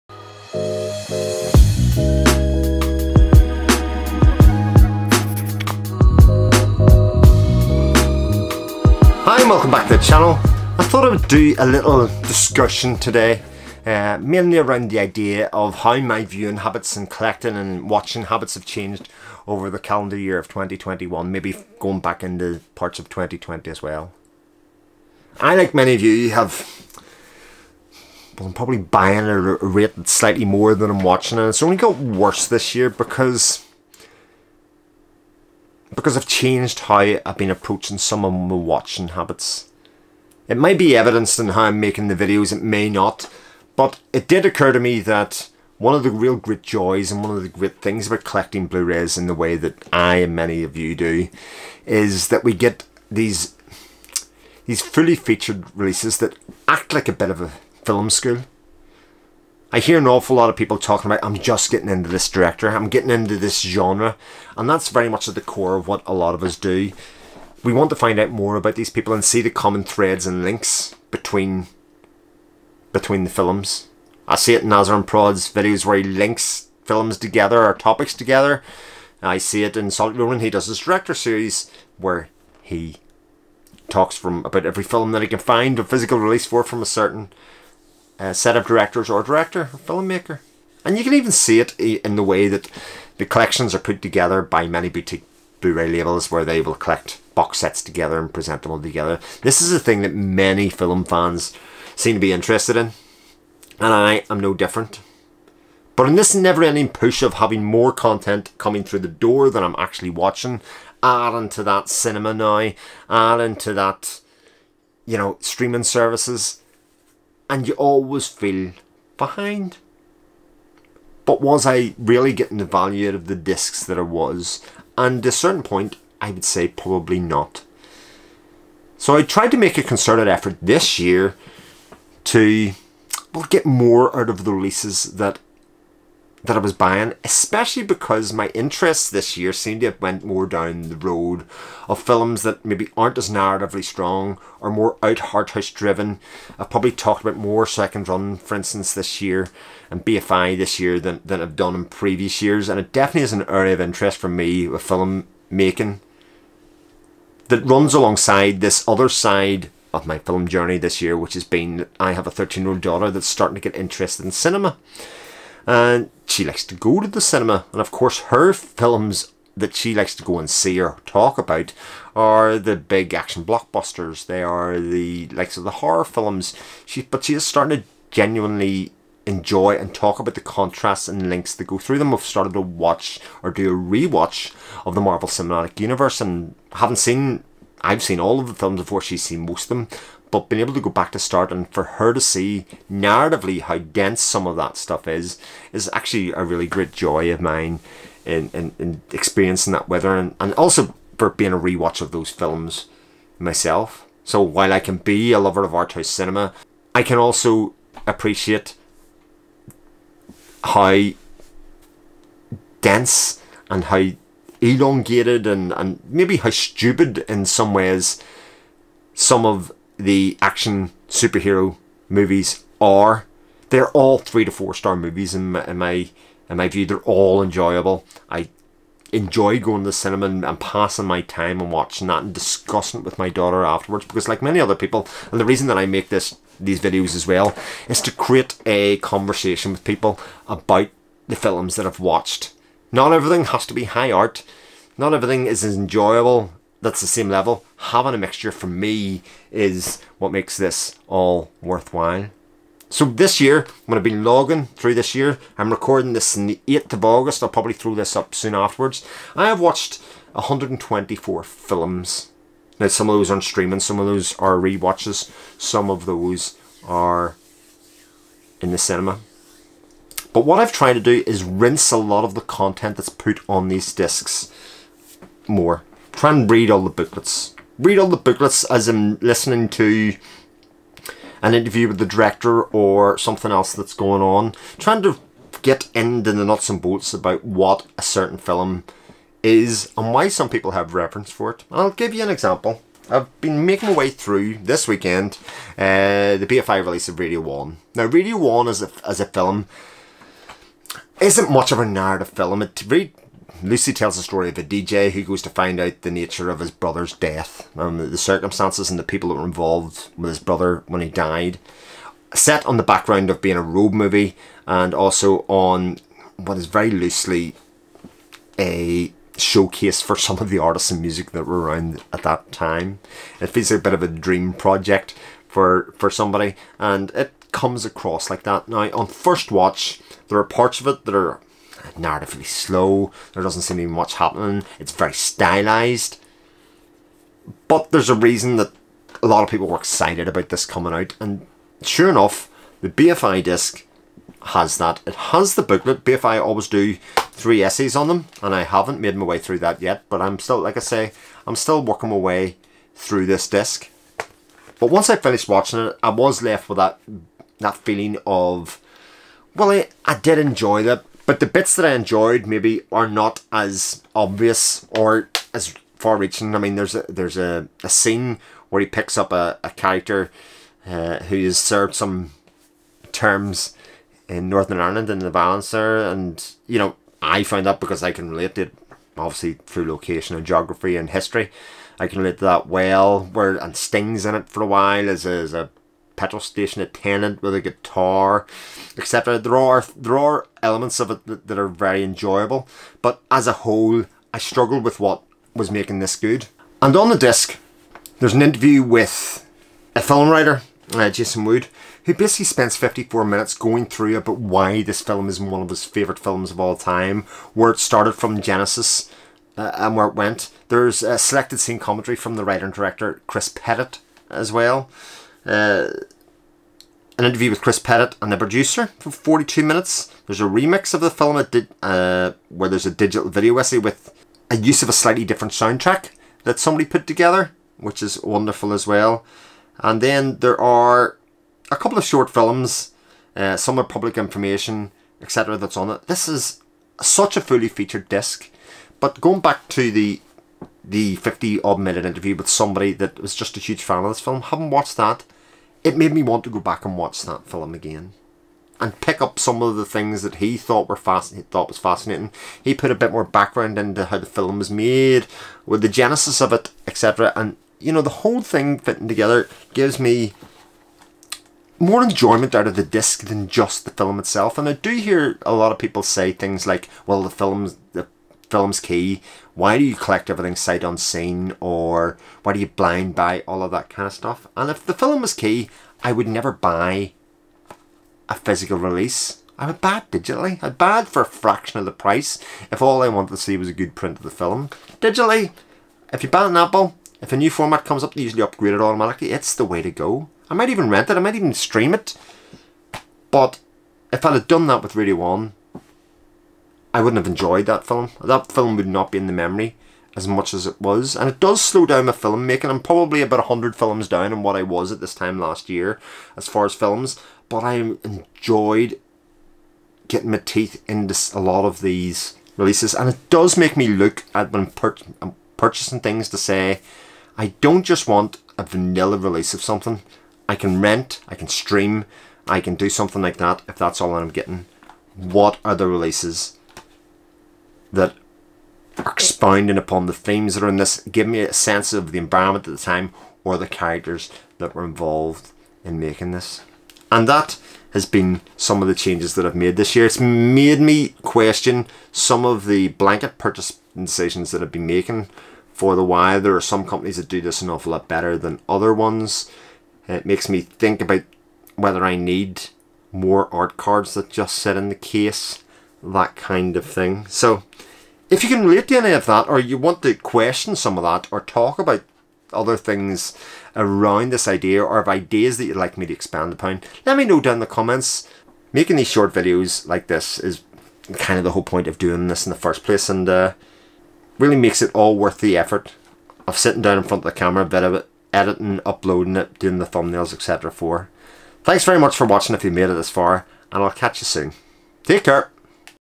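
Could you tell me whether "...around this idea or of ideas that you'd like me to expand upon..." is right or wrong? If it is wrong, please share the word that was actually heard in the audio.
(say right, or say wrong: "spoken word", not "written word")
right.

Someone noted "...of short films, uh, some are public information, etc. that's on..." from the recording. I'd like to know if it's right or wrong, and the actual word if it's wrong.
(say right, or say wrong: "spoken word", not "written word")
right.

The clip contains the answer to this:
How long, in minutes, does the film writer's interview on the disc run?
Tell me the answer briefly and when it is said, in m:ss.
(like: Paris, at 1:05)
54, at 6:42.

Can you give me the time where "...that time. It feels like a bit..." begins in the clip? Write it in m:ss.
5:22.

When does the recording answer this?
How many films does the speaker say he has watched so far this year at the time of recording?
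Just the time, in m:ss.
4:20.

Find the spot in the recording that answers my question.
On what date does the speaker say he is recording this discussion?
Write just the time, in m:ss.
4:16.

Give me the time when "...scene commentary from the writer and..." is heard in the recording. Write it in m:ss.
6:51.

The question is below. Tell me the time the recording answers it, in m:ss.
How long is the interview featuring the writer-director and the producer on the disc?
6:59.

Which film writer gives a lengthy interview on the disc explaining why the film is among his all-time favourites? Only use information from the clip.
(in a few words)
Jason Wood.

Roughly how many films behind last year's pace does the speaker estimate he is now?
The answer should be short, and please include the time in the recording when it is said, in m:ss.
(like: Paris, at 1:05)
100, at 8:23.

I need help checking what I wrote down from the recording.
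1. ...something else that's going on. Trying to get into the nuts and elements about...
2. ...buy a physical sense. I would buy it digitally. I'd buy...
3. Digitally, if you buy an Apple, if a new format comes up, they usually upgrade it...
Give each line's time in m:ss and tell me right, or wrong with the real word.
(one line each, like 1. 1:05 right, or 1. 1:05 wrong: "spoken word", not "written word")
1. 4:43 wrong: "bolts", not "elements"
2. 7:56 wrong: "release", not "sense"
3. 8:04 right.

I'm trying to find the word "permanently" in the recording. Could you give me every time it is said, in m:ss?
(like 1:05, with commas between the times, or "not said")
not said.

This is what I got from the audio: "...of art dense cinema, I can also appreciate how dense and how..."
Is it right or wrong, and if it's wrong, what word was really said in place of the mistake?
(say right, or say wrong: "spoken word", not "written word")
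wrong: "house", not "dense".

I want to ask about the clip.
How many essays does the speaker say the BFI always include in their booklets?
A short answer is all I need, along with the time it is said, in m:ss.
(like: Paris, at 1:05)
3, at 5:47.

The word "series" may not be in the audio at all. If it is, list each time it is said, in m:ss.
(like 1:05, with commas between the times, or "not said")
1:21.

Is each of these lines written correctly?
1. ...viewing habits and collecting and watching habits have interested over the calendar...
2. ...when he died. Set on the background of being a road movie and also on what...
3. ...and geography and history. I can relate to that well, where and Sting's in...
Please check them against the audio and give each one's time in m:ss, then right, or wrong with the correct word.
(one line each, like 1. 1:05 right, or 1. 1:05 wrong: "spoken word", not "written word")
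1. 0:16 wrong: "changed", not "interested"
2. 5:10 right
3. 6:20 right.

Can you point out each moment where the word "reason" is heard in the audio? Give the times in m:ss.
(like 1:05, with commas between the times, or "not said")
3:55, 5:38.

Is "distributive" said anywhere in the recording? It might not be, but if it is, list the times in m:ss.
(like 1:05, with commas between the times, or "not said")
not said.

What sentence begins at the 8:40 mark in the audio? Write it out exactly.
I can rent, I can stream, I can do something like that if that's all I'm getting.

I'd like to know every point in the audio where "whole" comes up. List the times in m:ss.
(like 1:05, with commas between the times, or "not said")
6:33, 7:38, 9:31.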